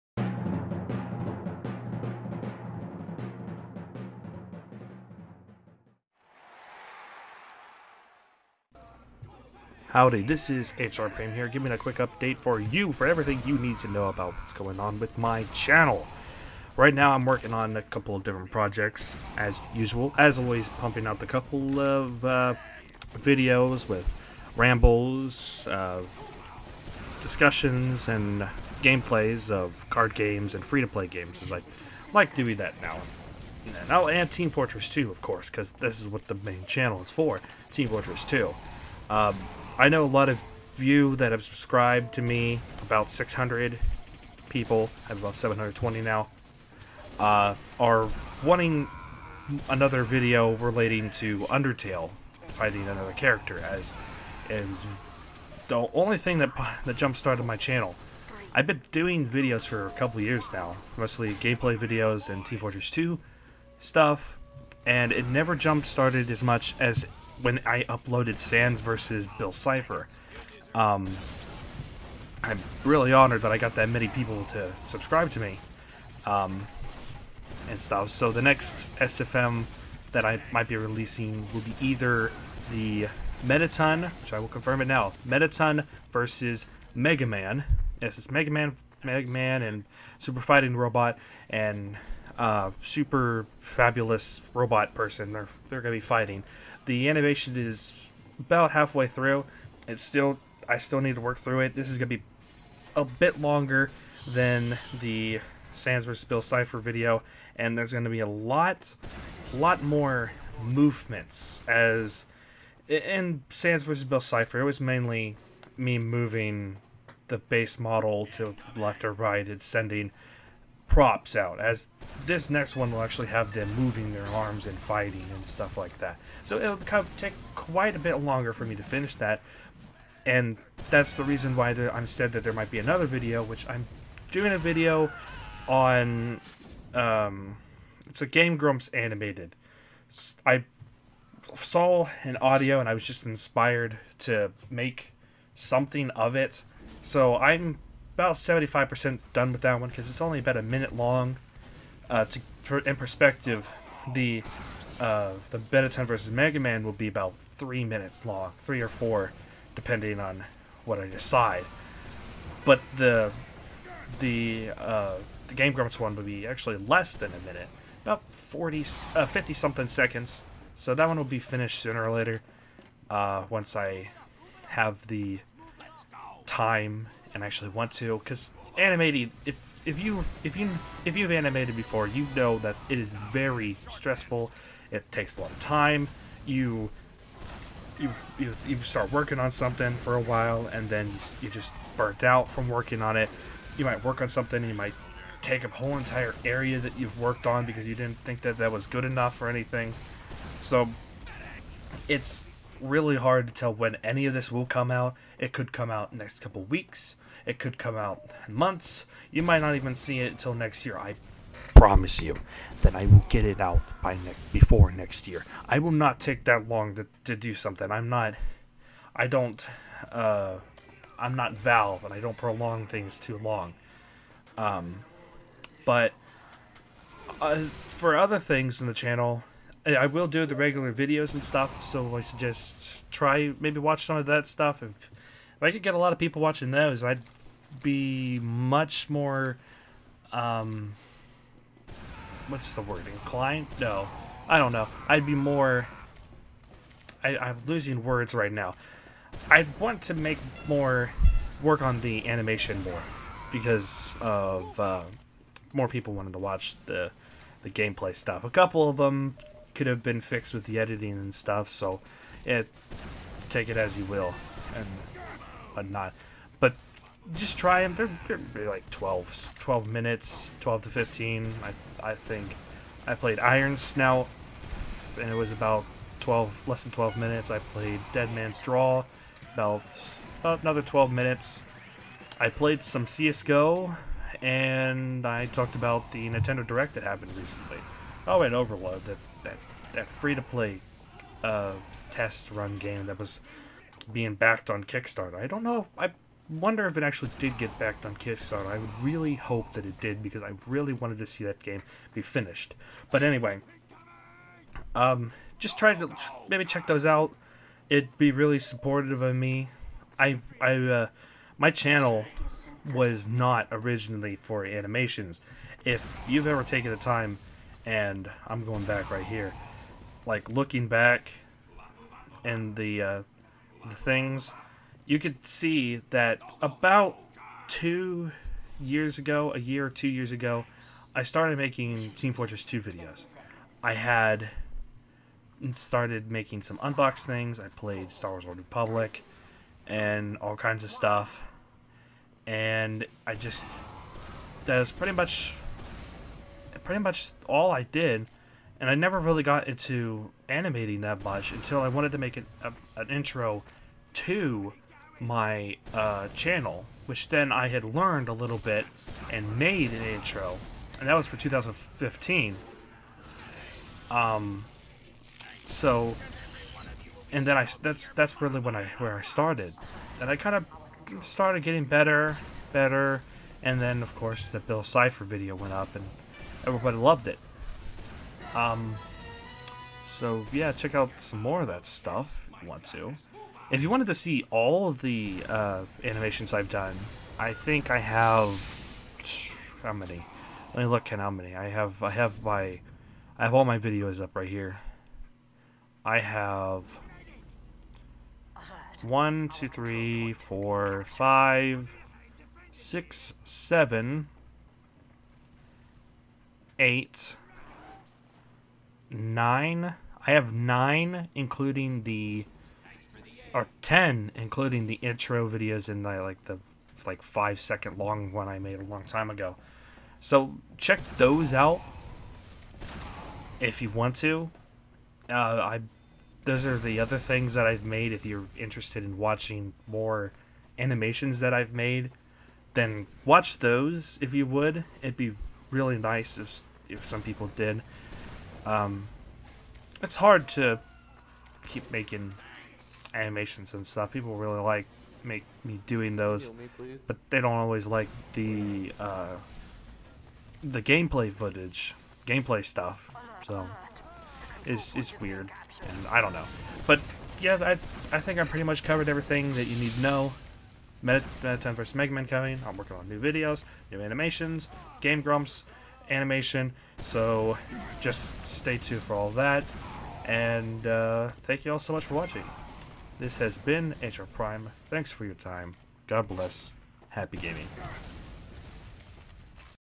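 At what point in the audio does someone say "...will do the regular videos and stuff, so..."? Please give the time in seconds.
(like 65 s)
230 s.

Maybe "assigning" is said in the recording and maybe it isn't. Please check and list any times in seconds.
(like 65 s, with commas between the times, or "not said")
not said.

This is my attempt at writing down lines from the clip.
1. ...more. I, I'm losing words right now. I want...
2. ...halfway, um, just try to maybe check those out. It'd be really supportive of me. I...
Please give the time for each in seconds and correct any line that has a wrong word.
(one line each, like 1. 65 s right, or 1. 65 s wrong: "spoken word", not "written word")
1. 245 s right
2. 303 s wrong: "anyway", not "halfway".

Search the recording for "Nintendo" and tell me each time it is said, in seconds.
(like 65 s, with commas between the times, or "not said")
286 s.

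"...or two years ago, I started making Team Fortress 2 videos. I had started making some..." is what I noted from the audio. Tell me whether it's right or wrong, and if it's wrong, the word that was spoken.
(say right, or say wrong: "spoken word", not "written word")
right.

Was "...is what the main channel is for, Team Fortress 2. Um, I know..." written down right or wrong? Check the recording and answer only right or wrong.
right.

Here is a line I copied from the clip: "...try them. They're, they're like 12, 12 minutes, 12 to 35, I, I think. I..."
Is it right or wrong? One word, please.
wrong.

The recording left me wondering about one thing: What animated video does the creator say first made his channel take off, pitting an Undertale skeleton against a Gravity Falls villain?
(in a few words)
Sans versus Bill Cipher.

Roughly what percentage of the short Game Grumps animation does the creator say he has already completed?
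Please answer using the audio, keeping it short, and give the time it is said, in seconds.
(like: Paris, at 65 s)
75%, at 148 s.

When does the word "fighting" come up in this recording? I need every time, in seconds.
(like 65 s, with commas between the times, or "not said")
90 s, 95 s, 124 s.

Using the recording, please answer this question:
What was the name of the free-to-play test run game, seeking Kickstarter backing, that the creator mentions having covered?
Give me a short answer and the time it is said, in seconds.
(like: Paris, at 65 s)
Overload, at 288 s.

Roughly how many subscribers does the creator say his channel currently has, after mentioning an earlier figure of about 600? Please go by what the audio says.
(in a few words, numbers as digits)
720.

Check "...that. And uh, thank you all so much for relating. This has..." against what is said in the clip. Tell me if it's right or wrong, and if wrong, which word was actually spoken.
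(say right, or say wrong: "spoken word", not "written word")
wrong: "watching", not "relating".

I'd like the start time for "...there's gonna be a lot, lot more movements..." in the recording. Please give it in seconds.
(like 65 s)
107 s.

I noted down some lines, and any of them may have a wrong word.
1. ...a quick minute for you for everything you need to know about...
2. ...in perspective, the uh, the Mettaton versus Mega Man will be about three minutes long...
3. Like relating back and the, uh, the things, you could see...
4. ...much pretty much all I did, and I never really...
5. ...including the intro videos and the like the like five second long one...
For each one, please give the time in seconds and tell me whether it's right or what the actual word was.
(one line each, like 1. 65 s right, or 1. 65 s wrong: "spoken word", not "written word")
1. 11 s wrong: "update", not "minute"
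2. 152 s right
3. 320 s wrong: "looking", not "relating"
4. 345 s right
5. 414 s right.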